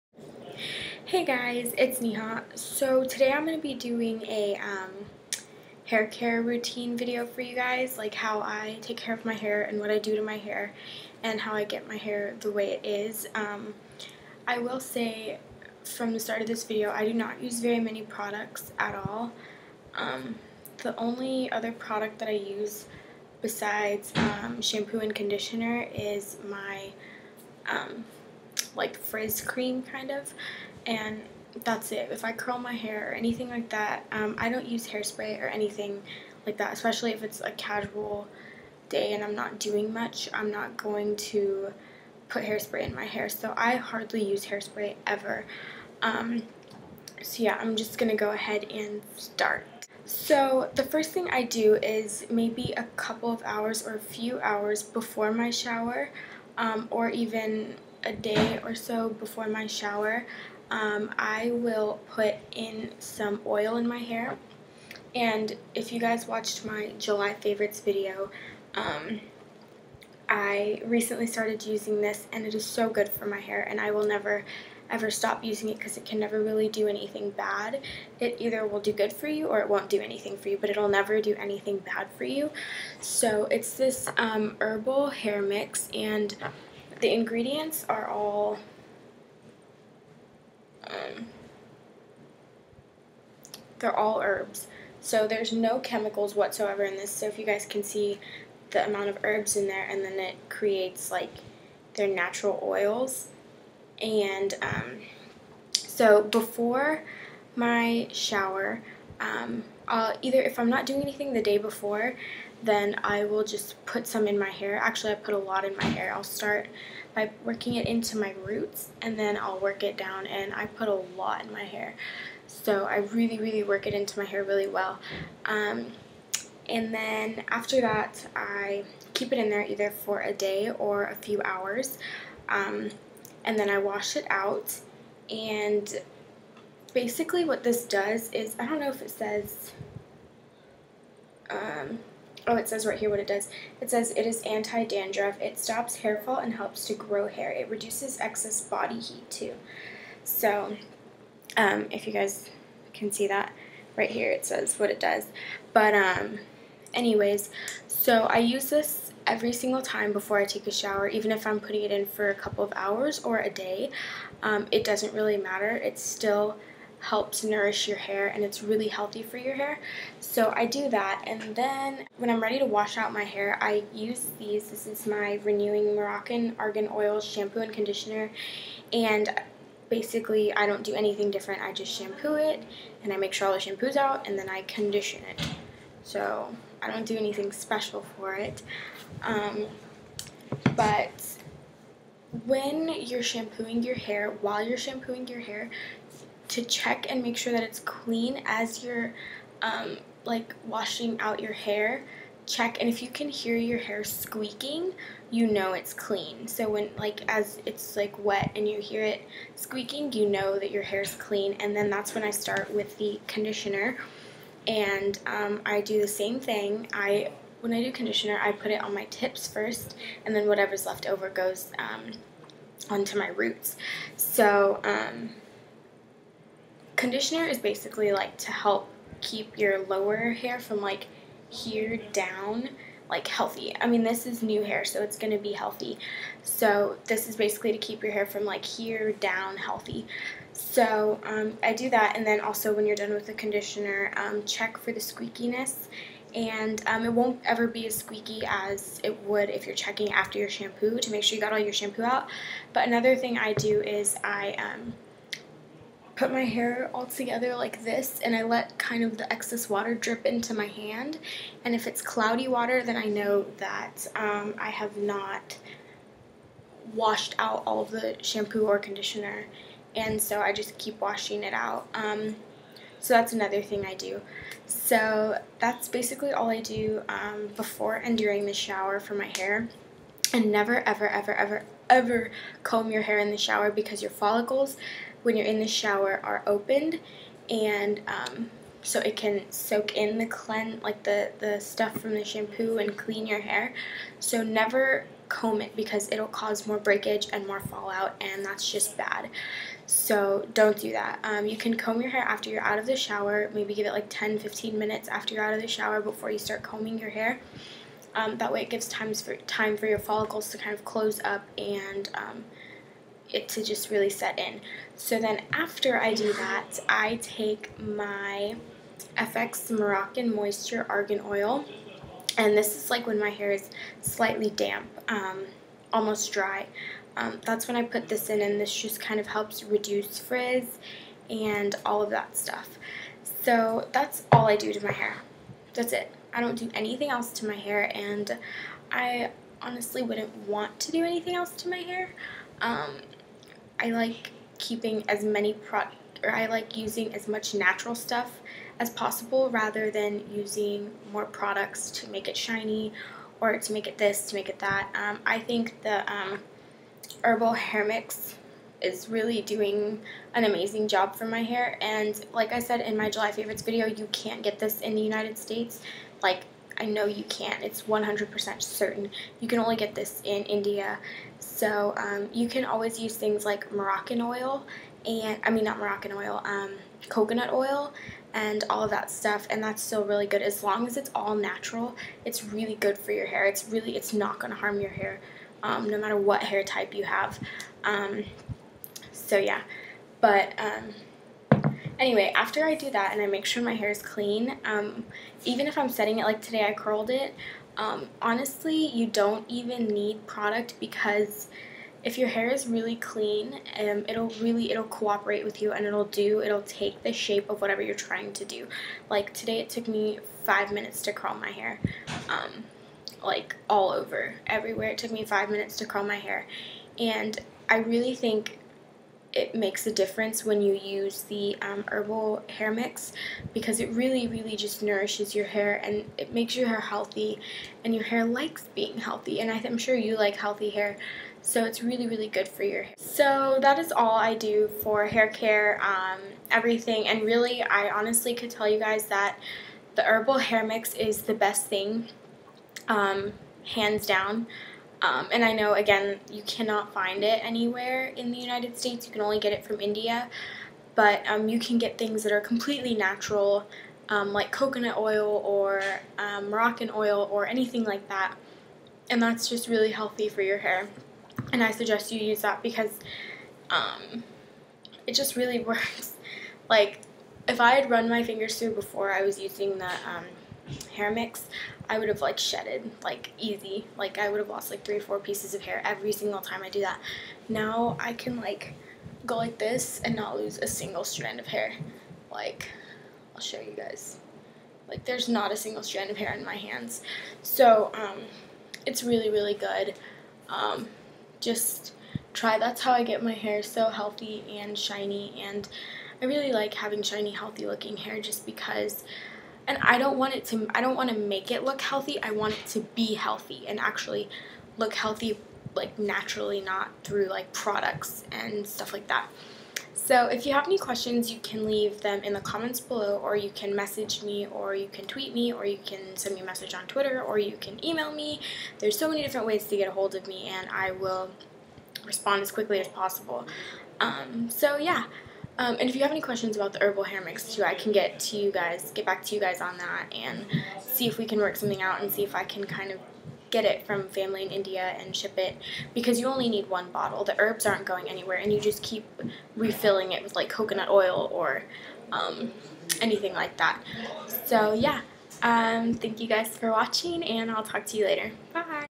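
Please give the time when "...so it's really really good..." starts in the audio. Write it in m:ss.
7:11.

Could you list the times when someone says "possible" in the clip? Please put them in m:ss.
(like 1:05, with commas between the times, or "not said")
5:48, 8:42.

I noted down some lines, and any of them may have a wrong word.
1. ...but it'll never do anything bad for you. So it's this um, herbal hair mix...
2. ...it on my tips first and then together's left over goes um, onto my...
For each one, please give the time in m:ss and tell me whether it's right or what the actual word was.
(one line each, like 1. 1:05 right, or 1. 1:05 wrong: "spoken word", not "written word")
1. 1:20 right
2. 3:38 wrong: "whatever", not "together".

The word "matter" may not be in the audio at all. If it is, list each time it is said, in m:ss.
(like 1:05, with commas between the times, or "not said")
2:45, 6:25.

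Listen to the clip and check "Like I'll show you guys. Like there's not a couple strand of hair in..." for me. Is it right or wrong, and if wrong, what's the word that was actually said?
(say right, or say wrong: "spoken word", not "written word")
wrong: "single", not "couple".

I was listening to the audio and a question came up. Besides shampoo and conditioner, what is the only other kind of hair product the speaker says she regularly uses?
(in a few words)
frizz cream.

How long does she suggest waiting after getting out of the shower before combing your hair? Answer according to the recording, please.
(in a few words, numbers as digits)
10-15 minutes.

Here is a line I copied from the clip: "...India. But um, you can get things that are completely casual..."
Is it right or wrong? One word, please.
wrong.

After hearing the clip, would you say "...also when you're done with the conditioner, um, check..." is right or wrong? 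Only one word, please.
right.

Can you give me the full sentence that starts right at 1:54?
Actually, I put a lot in my hair.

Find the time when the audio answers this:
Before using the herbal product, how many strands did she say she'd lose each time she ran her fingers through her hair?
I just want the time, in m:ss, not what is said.
7:54.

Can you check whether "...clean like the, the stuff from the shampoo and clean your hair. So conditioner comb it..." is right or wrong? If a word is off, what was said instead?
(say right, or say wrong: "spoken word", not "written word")
wrong: "never", not "conditioner".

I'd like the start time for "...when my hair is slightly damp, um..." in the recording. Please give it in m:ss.
5:23.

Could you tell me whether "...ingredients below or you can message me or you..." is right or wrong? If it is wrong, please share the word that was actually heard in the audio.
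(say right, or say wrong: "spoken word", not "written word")
wrong: "comments", not "ingredients".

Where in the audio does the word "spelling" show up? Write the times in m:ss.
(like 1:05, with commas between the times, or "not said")
not said.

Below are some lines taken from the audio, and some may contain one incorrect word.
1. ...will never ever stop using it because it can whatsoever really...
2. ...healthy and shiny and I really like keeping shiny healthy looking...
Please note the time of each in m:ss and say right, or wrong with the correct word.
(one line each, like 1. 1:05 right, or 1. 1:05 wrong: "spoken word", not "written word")
1. 1:13 wrong: "never", not "whatsoever"
2. 8:13 wrong: "having", not "keeping".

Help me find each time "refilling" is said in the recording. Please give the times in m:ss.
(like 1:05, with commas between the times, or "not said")
8:59.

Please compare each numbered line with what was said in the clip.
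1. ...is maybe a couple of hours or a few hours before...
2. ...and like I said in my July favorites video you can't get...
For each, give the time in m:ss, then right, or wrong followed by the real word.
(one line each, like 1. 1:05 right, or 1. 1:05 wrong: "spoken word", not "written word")
1. 0:51 right
2. 6:01 right.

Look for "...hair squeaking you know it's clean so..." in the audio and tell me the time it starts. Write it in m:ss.
3:23.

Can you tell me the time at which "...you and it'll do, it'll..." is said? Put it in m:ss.
6:45.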